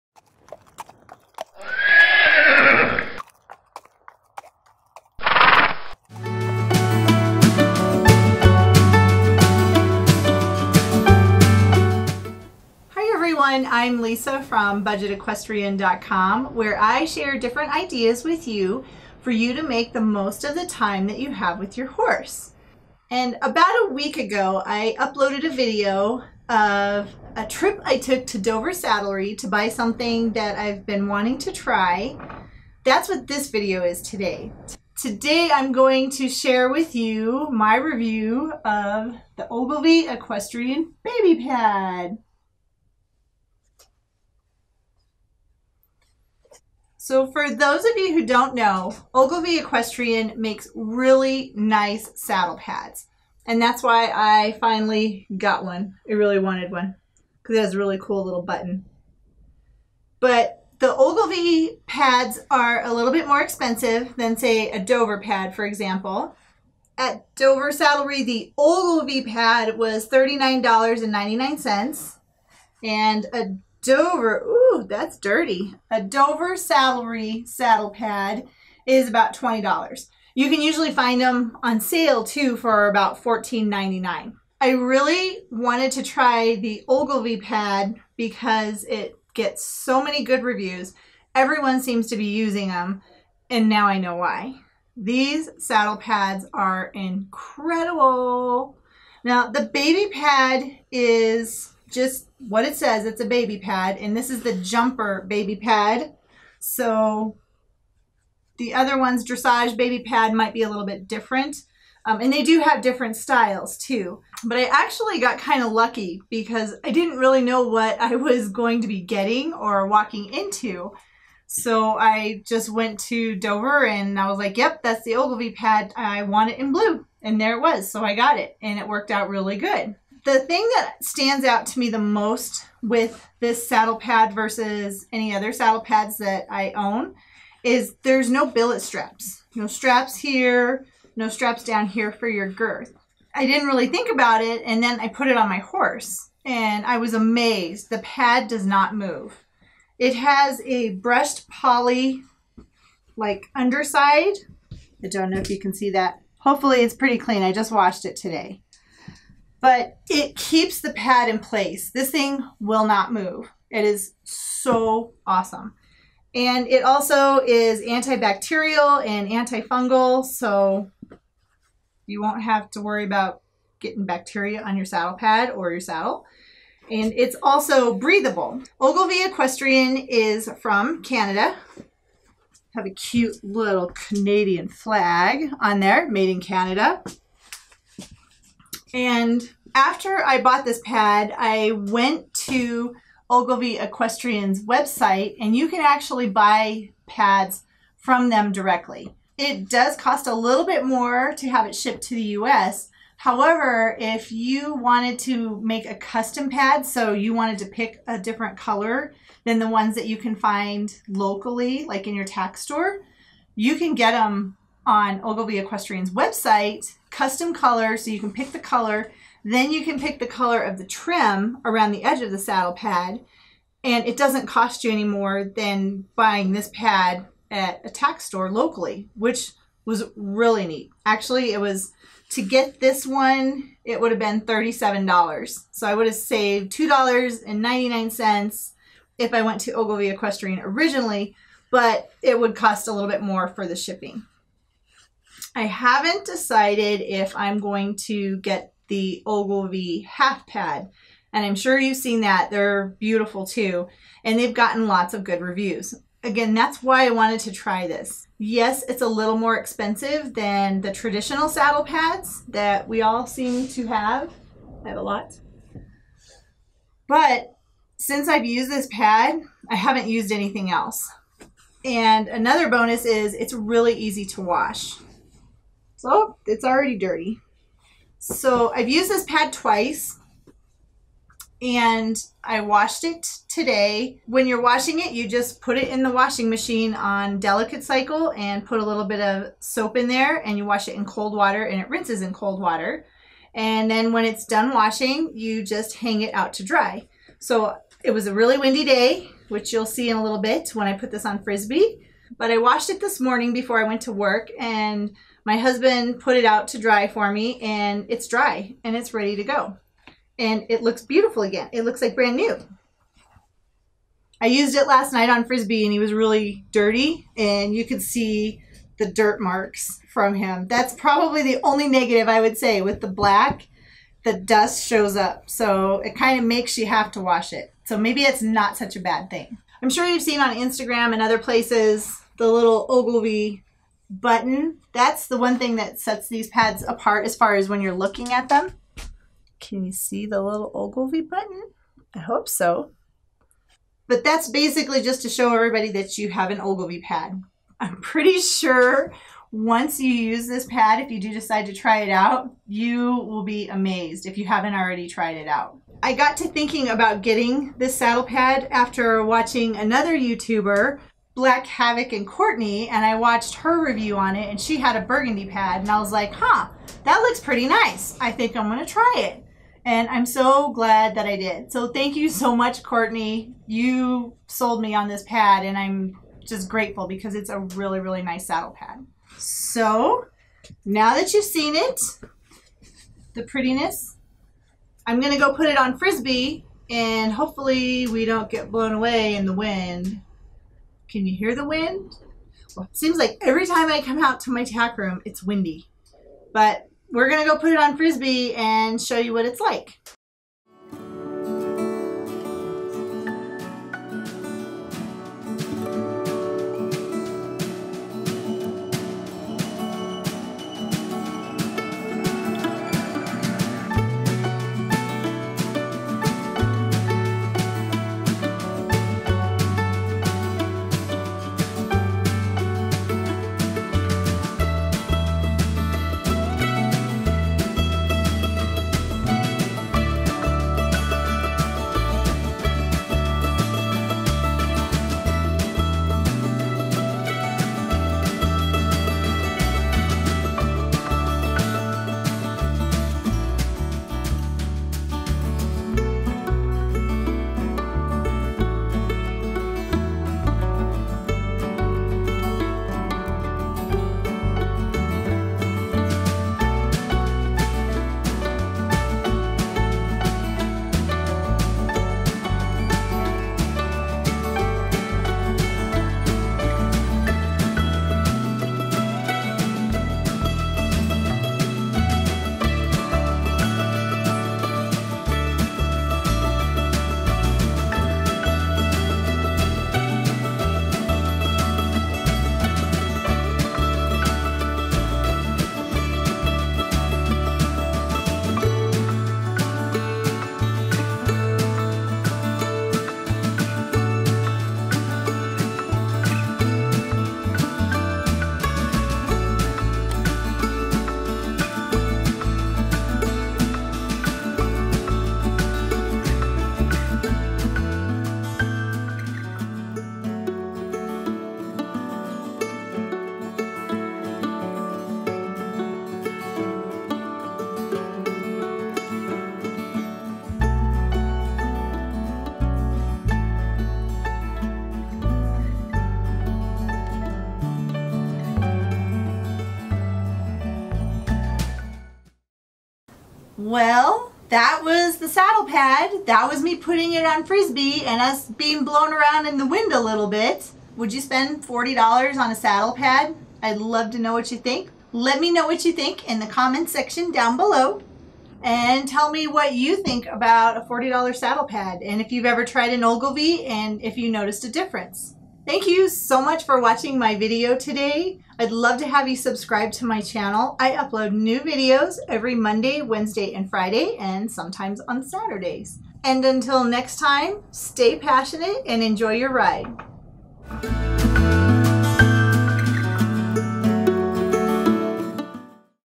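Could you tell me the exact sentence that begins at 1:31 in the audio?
Everyone seems to be using them, and now I know why.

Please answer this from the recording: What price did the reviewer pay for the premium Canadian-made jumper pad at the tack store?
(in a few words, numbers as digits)
$39.99.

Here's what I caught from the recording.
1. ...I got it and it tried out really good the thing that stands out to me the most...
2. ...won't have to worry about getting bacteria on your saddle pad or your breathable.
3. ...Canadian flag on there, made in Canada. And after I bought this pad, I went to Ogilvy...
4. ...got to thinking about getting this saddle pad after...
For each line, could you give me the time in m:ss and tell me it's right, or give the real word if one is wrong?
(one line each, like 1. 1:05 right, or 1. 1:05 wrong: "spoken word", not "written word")
1. 2:08 wrong: "worked", not "tried"
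2. 2:52 wrong: "saddle", not "breathable"
3. 3:03 right
4. 5:56 right.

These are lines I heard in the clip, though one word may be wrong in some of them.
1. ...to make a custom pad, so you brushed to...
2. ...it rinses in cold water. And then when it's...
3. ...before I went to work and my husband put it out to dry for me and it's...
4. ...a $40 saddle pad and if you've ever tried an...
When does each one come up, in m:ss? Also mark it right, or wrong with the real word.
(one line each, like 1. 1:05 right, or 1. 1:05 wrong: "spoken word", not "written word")
1. 3:25 wrong: "wanted", not "brushed"
2. 4:51 right
3. 5:03 right
4. 9:10 right.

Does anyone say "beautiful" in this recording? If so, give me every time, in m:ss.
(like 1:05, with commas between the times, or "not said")
4:12, 5:11.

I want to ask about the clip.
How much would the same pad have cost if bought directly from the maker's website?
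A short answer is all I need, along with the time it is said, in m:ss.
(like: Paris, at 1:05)
$37, at 3:54.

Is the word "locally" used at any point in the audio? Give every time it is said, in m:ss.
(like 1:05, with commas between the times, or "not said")
3:31, 3:48.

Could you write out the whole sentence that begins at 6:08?
I think I'm gonna try it.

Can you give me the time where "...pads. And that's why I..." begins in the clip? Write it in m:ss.
0:52.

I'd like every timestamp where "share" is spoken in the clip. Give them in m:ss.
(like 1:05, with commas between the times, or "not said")
0:17, 0:36.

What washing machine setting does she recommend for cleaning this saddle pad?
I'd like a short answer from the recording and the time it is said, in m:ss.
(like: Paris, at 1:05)
delicate cycle, at 4:47.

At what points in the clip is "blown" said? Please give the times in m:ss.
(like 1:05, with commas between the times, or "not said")
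6:28, 8:58.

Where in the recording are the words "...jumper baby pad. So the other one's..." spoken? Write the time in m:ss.
1:44.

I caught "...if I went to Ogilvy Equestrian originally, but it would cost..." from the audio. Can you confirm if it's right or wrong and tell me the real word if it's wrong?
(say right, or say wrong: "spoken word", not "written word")
right.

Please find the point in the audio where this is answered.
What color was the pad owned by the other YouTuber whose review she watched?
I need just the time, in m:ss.
6:05.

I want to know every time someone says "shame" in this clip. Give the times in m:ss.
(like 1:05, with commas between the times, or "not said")
not said.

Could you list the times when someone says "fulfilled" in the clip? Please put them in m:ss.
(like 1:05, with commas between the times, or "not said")
not said.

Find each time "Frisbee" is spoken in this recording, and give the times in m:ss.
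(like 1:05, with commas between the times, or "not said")
5:01, 5:15, 6:25, 6:37, 8:57.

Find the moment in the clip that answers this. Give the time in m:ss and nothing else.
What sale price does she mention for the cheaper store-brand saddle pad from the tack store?
1:23.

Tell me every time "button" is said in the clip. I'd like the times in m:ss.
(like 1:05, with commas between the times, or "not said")
0:58, 5:34, 5:41.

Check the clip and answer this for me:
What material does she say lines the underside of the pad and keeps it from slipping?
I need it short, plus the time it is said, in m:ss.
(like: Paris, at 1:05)
brushed poly, at 2:30.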